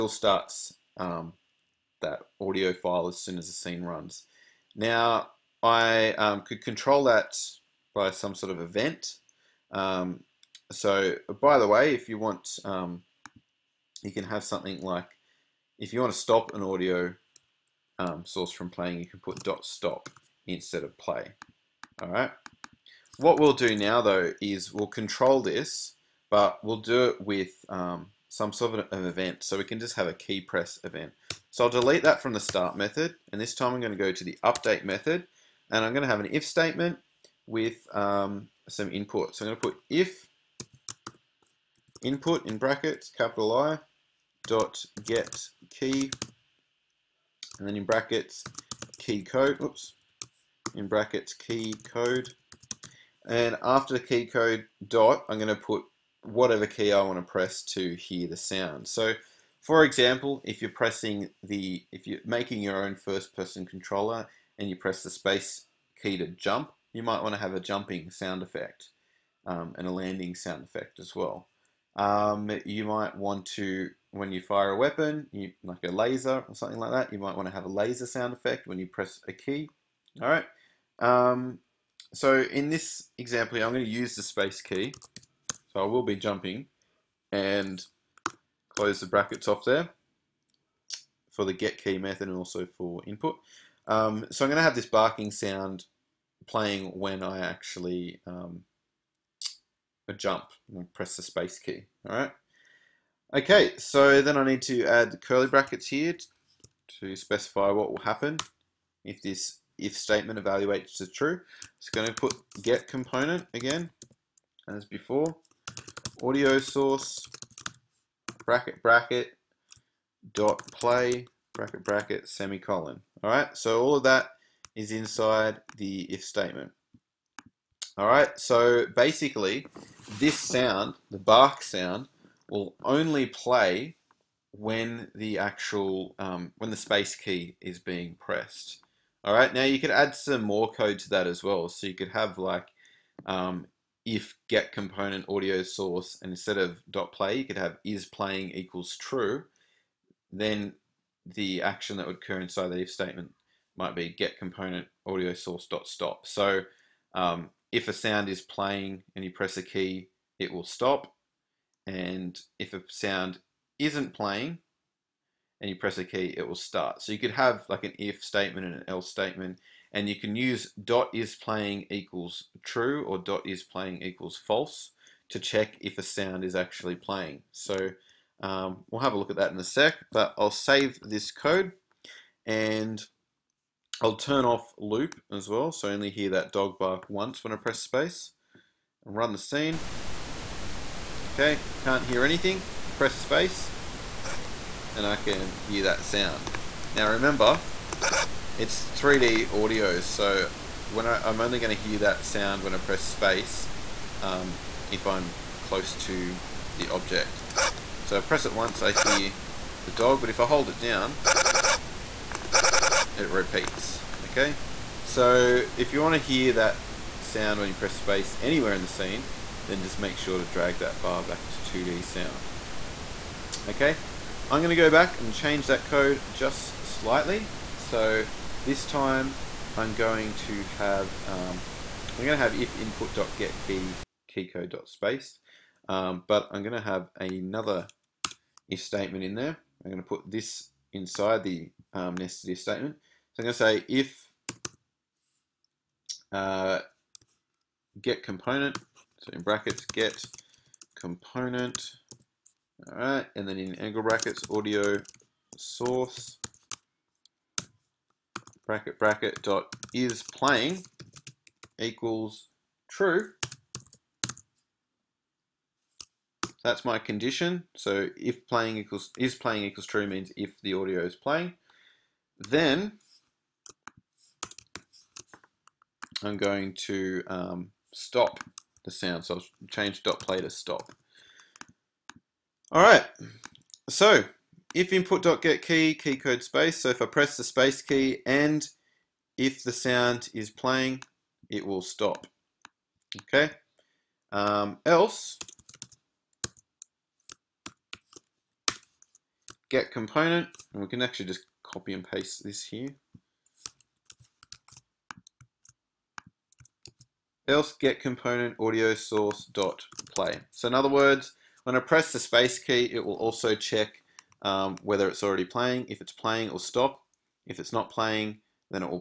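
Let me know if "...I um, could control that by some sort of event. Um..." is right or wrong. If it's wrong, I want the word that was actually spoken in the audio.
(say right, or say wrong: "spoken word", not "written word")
right.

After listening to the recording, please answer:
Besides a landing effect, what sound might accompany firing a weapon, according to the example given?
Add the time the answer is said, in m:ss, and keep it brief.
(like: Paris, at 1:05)
Laser sound effect, at 1:17.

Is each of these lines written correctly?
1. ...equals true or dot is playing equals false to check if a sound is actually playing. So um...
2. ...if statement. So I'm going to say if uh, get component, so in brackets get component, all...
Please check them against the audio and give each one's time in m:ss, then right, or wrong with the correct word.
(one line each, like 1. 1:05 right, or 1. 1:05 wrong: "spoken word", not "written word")
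1. 2:51 right
2. 4:02 right.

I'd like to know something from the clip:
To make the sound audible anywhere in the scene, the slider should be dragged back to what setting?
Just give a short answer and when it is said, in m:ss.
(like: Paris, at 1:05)
2D sound, at 3:41.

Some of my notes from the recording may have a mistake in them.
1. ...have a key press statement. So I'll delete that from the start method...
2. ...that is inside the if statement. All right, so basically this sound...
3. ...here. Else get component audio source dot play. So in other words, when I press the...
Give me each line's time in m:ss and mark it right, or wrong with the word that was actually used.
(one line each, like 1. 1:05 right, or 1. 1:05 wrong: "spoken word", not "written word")
1. 0:29 wrong: "event", not "statement"
2. 2:04 right
3. 5:02 right.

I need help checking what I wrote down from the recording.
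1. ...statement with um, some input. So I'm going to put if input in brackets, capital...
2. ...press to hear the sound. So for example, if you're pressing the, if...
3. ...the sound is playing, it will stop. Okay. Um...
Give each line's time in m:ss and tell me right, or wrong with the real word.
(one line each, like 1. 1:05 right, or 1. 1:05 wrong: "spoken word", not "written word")
1. 0:36 right
2. 0:57 right
3. 4:49 right.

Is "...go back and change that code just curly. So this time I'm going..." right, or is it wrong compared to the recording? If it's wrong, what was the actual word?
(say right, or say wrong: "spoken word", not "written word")
wrong: "slightly", not "curly".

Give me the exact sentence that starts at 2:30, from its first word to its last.
Then the action that would occur inside the if statement might be get component audio source dot stop.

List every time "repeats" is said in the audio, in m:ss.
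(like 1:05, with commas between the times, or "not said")
3:33.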